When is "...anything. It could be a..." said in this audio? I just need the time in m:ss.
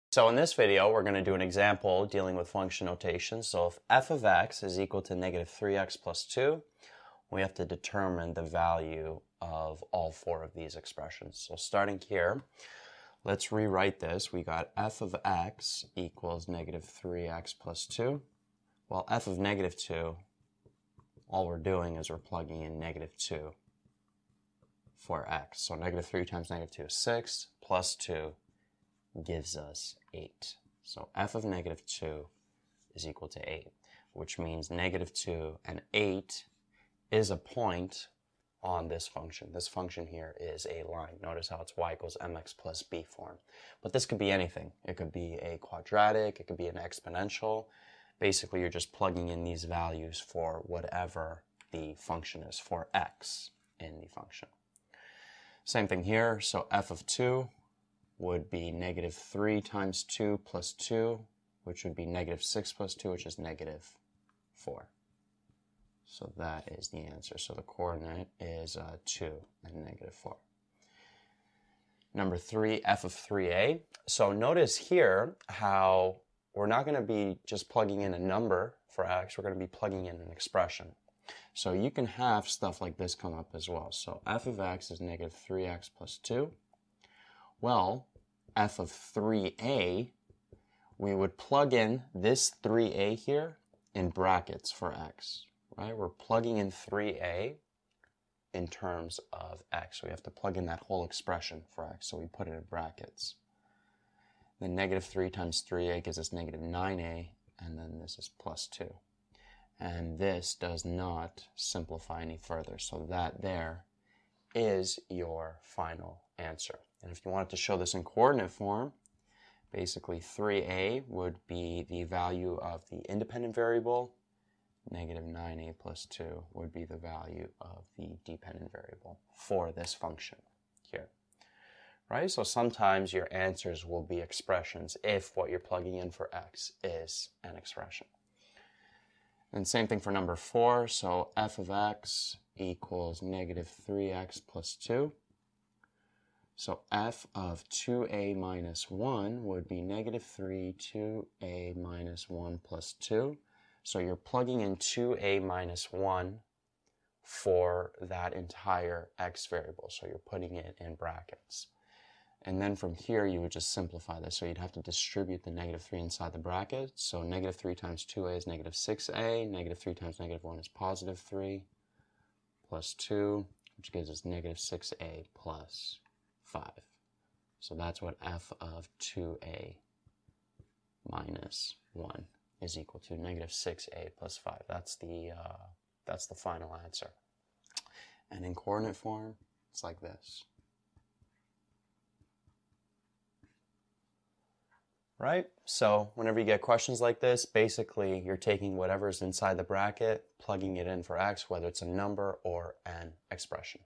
0:44.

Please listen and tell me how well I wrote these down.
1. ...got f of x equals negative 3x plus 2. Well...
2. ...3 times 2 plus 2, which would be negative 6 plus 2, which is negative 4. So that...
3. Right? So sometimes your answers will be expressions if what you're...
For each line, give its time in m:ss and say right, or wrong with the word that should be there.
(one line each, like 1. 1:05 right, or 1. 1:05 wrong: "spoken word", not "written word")
1. 0:14 right
2. 0:59 right
3. 2:12 right.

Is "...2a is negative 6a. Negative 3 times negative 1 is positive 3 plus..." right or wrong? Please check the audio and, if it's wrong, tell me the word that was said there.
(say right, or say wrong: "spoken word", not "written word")
right.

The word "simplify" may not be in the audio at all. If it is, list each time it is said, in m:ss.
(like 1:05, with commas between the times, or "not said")
1:51, 2:43.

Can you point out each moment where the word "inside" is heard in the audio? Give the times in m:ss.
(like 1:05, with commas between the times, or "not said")
2:45, 3:19.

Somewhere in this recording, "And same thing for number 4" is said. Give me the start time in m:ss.
2:19.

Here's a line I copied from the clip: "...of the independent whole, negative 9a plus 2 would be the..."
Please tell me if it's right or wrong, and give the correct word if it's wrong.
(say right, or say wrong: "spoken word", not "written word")
wrong: "variable", not "whole".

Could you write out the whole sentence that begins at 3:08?
And in coordinate form, it's like this.